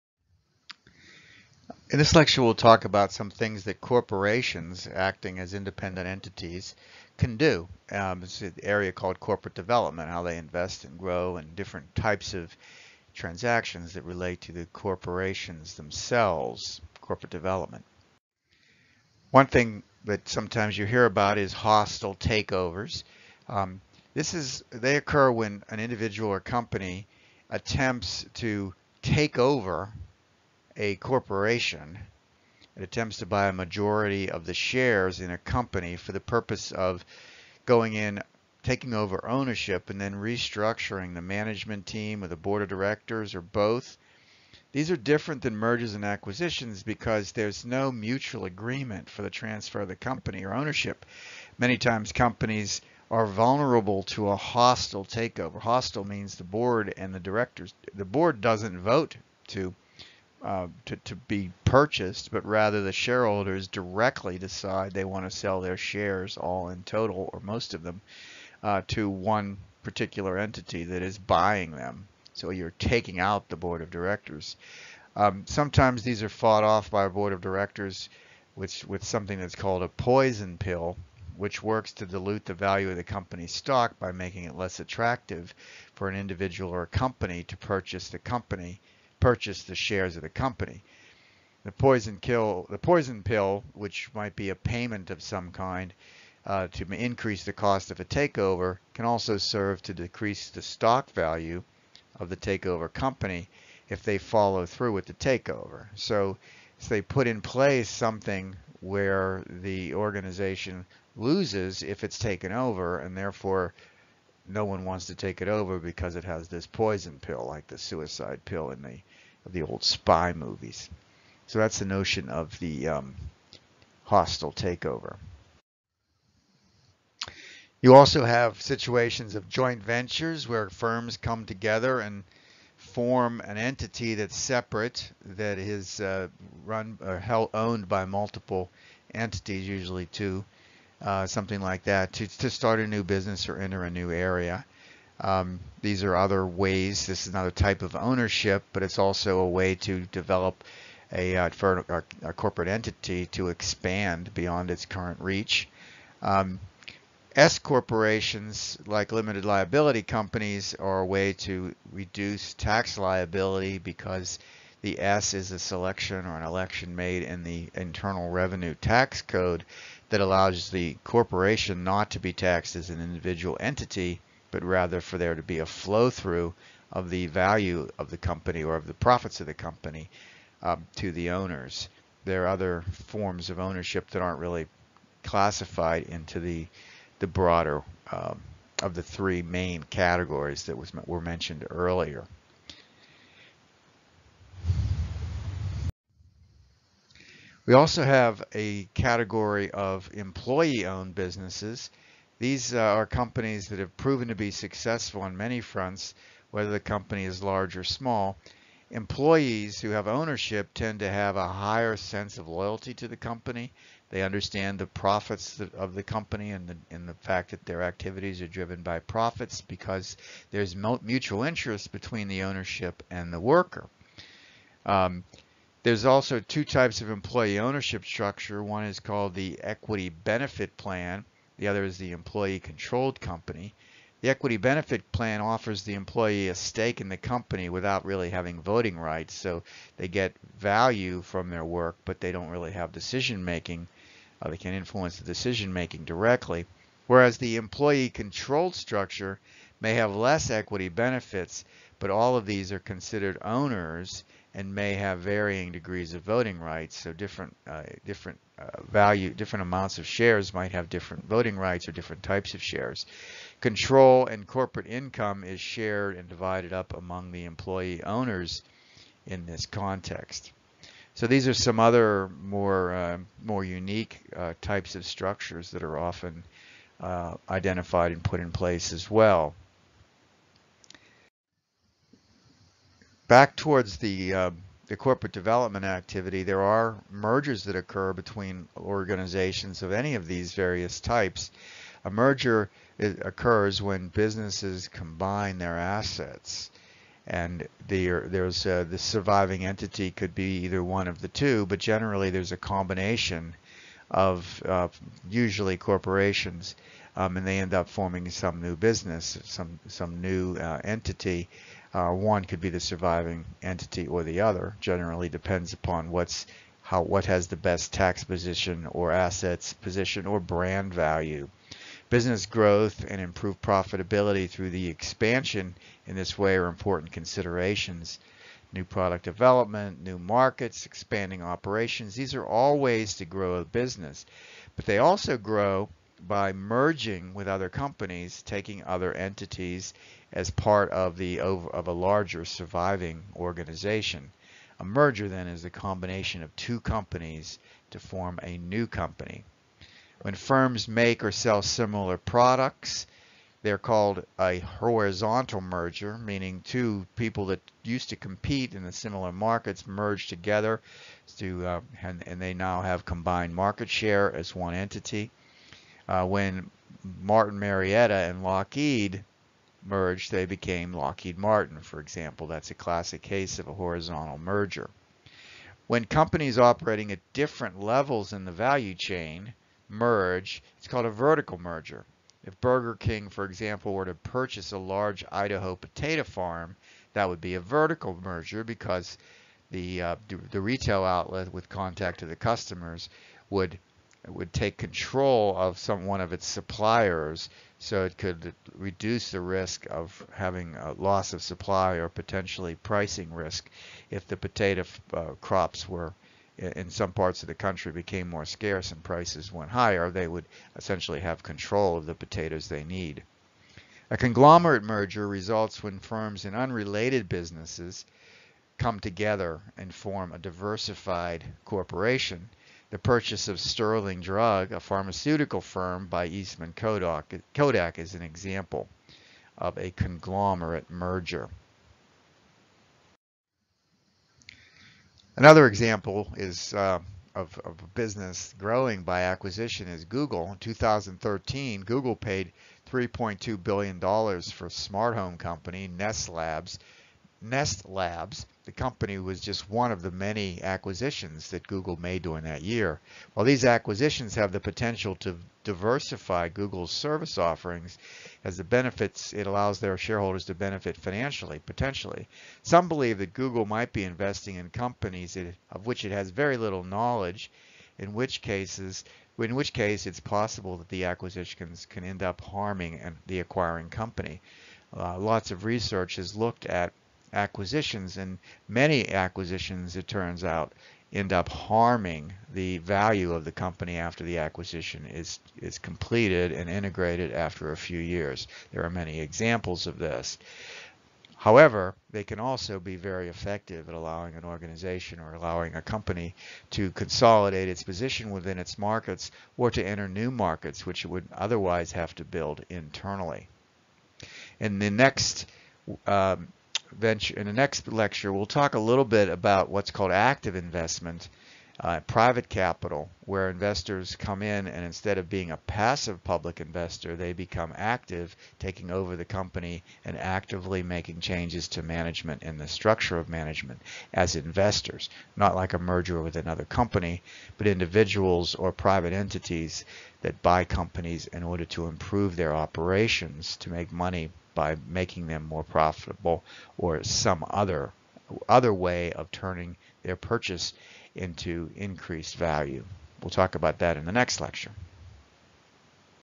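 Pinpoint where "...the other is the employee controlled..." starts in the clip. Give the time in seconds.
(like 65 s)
231 s.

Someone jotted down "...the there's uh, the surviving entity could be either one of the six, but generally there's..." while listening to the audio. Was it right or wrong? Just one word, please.
wrong.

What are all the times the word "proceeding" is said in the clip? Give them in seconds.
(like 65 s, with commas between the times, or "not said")
not said.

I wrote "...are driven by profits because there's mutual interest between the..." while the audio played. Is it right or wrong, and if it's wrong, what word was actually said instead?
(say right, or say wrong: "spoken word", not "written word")
right.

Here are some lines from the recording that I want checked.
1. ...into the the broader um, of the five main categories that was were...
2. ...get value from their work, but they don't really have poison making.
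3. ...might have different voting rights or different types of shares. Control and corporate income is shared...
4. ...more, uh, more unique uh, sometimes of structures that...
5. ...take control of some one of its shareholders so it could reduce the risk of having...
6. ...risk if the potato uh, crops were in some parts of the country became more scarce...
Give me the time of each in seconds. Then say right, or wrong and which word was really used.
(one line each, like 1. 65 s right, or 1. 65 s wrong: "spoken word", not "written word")
1. 186 s wrong: "three", not "five"
2. 240 s wrong: "decision", not "poison"
3. 260 s right
4. 272 s wrong: "types", not "sometimes"
5. 394 s wrong: "suppliers", not "shareholders"
6. 403 s right.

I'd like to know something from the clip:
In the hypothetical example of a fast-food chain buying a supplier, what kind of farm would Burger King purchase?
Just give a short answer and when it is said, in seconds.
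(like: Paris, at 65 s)
Idaho potato farm, at 385 s.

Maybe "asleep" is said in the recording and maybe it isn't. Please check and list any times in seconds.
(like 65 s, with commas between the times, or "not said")
not said.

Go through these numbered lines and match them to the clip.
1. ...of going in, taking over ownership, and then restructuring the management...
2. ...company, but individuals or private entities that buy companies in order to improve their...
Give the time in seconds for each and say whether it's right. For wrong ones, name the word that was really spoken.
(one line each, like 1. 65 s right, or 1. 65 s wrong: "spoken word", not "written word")
1. 36 s right
2. 526 s right.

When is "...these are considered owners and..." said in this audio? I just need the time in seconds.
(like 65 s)
252 s.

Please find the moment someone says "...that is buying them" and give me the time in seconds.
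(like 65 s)
70 s.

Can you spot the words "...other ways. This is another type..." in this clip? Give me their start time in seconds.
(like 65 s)
146 s.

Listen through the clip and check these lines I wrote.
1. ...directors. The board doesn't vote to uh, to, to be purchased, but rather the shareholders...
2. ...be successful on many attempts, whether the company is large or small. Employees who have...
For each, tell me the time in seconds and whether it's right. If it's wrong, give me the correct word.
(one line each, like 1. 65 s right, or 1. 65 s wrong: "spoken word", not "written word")
1. 57 s right
2. 204 s wrong: "fronts", not "attempts".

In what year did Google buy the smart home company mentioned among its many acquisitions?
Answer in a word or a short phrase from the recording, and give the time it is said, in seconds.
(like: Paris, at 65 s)
2013, at 440 s.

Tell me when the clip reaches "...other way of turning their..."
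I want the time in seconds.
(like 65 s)
538 s.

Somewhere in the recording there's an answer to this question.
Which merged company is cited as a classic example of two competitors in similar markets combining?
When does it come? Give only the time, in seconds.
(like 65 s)
370 s.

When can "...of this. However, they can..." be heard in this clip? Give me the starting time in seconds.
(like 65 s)
489 s.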